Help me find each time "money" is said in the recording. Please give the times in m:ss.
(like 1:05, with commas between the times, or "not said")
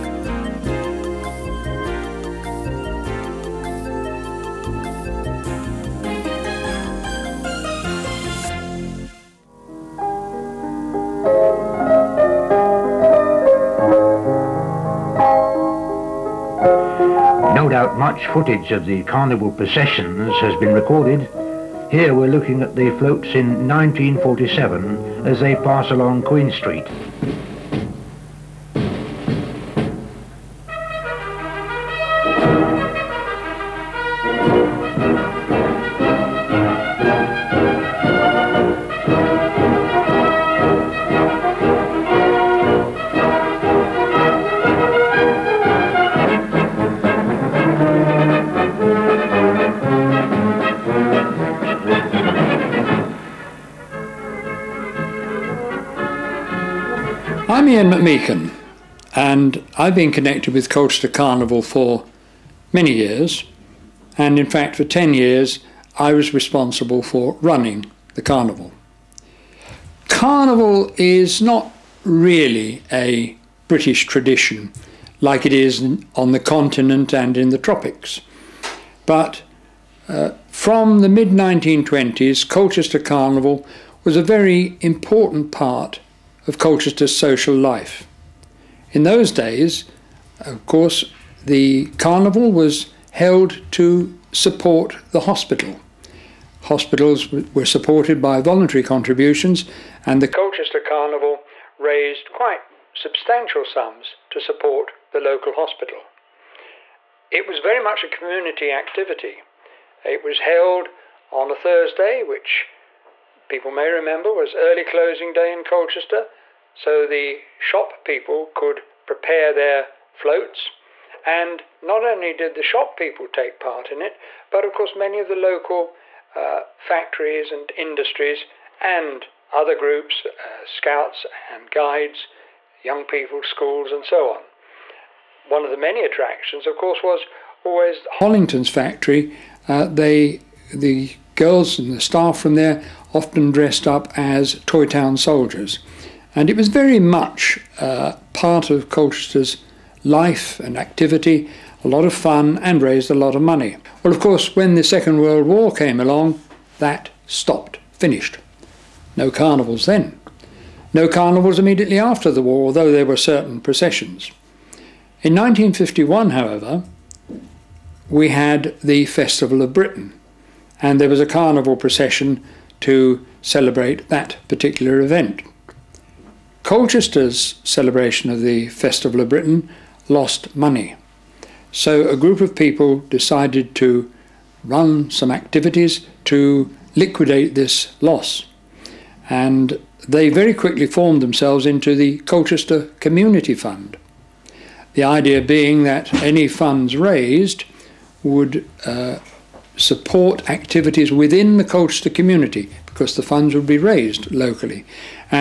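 2:33, 3:00.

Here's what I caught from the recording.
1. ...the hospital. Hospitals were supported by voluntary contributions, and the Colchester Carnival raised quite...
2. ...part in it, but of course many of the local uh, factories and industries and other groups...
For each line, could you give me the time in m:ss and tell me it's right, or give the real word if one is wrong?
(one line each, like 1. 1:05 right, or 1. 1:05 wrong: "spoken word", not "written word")
1. 1:35 right
2. 2:03 right.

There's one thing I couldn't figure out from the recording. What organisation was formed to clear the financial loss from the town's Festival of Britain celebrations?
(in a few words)
Colchester Community Fund.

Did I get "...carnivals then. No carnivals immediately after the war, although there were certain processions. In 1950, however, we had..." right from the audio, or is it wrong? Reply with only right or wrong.
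wrong.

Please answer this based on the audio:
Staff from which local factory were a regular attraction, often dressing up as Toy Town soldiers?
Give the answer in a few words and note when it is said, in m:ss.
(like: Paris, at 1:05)
Hollington's, at 2:18.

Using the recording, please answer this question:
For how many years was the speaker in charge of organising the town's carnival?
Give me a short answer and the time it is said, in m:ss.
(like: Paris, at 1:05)
10, at 1:04.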